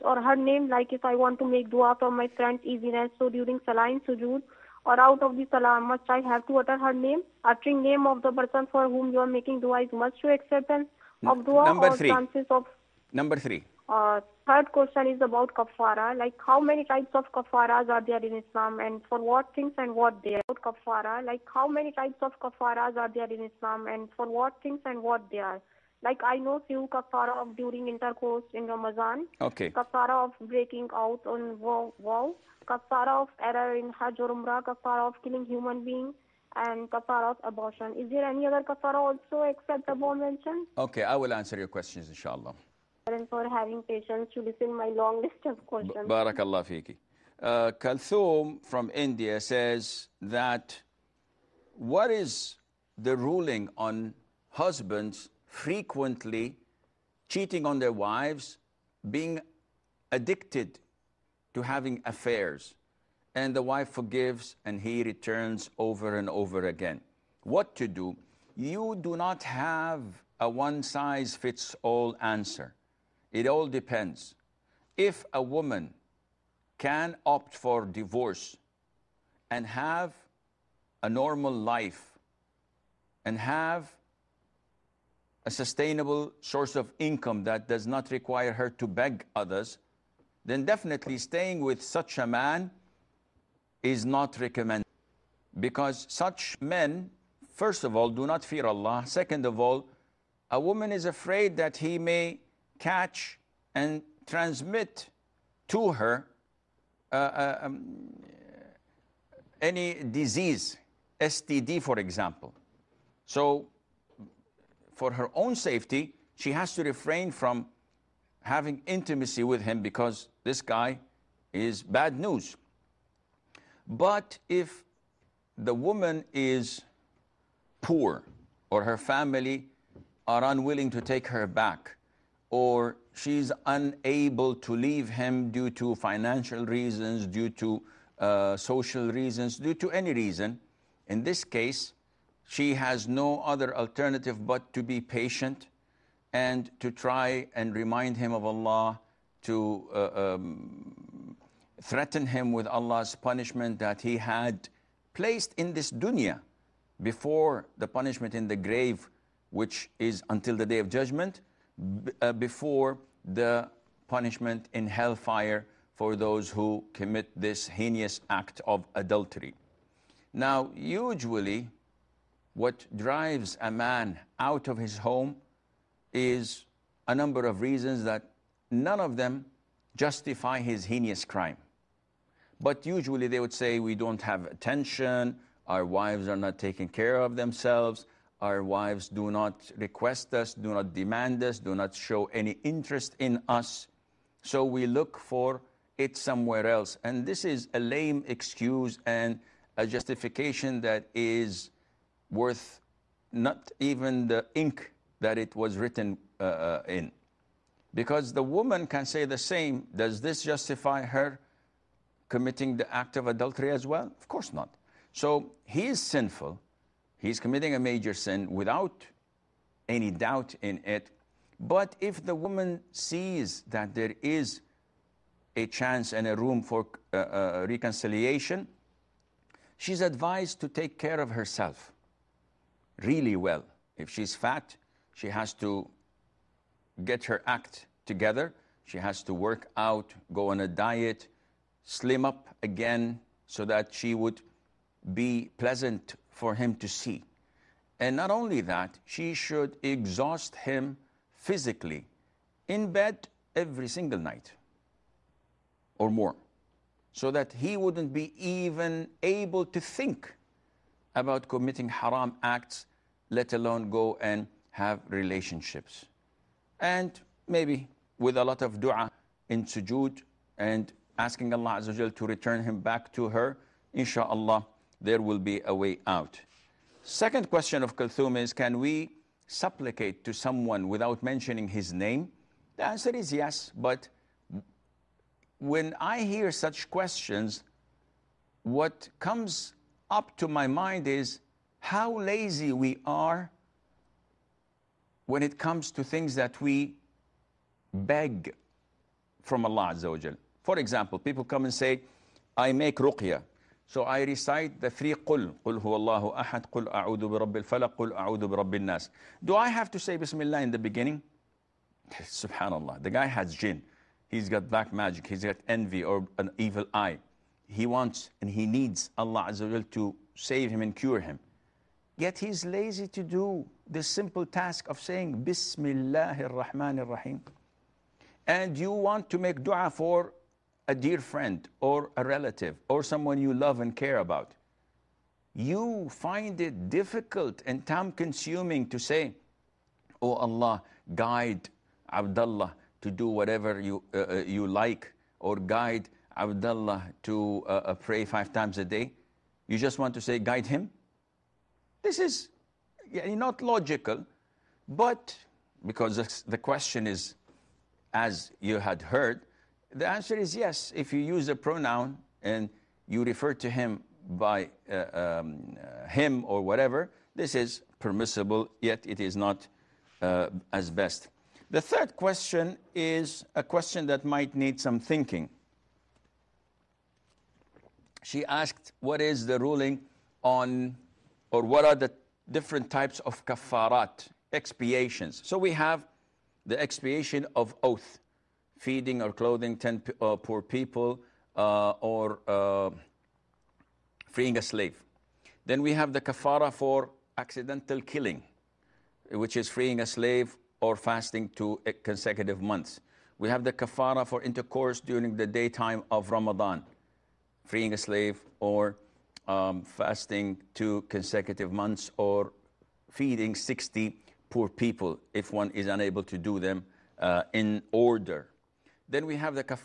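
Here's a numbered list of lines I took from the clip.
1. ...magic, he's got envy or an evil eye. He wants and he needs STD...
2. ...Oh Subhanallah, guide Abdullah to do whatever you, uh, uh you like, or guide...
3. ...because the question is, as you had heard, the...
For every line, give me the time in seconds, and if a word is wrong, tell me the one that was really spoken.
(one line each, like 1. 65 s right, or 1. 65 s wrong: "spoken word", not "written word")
1. 314 s wrong: "Allah", not "STD"
2. 340 s wrong: "Allah", not "Subhanallah"
3. 355 s right.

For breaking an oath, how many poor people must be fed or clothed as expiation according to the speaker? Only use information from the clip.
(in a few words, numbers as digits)
10.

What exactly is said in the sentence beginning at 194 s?
So we look for it somewhere else.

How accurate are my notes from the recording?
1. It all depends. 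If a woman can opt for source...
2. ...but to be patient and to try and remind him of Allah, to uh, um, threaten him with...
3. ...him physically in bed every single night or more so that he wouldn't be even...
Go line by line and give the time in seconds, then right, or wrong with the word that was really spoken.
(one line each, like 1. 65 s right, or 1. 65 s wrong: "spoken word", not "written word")
1. 73 s wrong: "divorce", not "source"
2. 144 s right
3. 250 s right.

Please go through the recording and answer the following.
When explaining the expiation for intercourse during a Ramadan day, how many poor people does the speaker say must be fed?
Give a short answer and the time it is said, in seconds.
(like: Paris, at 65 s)
60, at 413 s.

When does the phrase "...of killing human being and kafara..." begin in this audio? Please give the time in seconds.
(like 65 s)
35 s.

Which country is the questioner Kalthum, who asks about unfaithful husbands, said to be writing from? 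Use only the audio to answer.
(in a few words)
India.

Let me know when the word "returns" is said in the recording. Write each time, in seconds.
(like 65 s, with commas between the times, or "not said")
65 s, 272 s.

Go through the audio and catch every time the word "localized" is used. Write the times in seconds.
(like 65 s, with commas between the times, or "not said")
not said.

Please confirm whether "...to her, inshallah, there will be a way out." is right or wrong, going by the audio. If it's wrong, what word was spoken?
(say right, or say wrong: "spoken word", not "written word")
right.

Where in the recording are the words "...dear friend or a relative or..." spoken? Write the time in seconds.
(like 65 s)
330 s.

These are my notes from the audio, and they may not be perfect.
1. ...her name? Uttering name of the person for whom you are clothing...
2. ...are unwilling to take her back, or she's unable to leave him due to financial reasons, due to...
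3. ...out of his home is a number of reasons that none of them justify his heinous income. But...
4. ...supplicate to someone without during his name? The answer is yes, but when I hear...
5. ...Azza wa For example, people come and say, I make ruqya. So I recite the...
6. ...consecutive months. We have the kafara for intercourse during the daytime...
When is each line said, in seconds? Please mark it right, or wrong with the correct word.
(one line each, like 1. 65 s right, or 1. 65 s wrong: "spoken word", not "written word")
1. 6 s wrong: "making", not "clothing"
2. 130 s right
3. 174 s wrong: "crime", not "income"
4. 279 s wrong: "mentioning", not "during"
5. 299 s right
6. 402 s right.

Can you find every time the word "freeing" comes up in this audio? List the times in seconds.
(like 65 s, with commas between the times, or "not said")
394 s, 399 s, 407 s.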